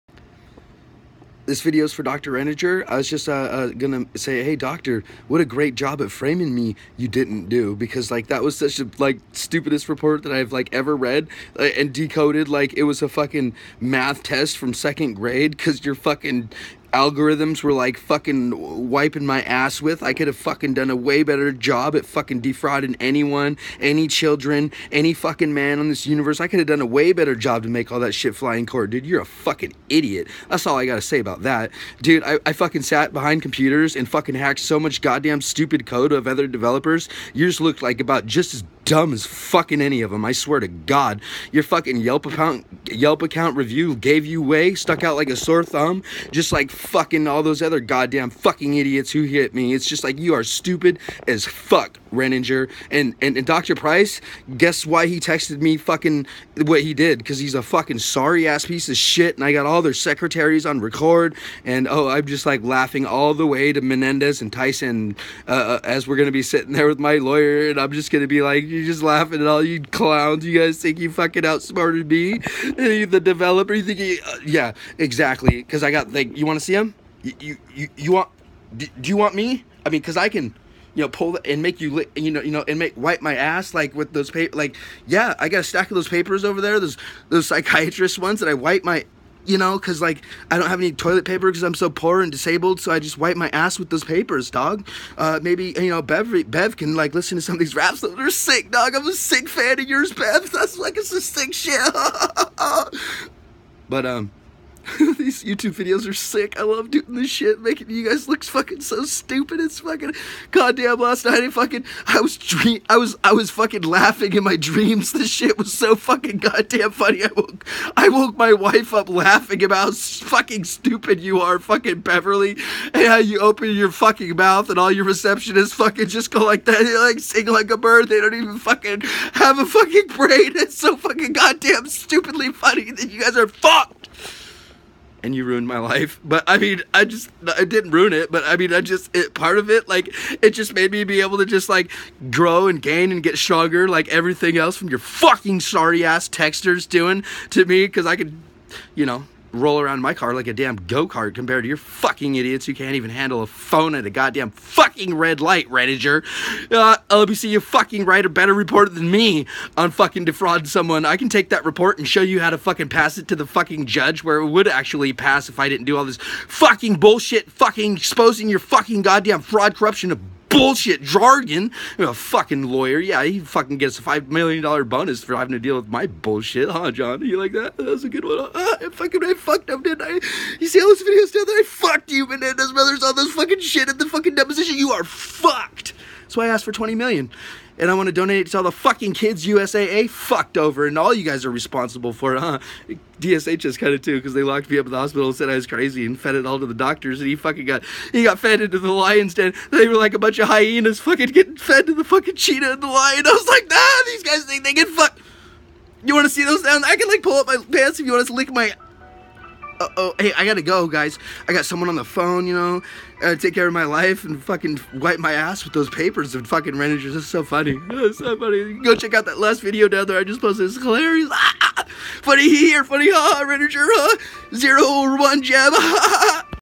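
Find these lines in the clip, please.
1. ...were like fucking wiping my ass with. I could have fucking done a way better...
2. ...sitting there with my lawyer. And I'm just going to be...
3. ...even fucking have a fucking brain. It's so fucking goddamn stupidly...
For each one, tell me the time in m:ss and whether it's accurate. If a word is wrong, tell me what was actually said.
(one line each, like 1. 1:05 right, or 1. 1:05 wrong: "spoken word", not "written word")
1. 0:17 right
2. 1:06 right
3. 2:08 right.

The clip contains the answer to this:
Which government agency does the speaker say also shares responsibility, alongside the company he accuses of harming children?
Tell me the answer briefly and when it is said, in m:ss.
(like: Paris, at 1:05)
DSHS, at 3:13.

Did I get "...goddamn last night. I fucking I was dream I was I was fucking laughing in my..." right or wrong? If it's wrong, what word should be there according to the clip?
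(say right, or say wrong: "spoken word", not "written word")
right.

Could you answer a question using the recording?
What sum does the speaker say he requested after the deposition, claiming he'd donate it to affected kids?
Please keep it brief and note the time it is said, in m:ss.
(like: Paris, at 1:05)
20 million, at 3:06.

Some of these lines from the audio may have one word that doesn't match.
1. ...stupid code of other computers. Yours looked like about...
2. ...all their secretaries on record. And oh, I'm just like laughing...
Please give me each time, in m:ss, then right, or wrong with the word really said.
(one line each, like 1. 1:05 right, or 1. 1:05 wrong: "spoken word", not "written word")
1. 0:35 wrong: "developers", not "computers"
2. 0:59 right.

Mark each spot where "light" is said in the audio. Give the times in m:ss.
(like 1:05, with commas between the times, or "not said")
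2:35.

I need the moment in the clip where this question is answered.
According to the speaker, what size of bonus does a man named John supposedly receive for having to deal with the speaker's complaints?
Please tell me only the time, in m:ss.
2:54.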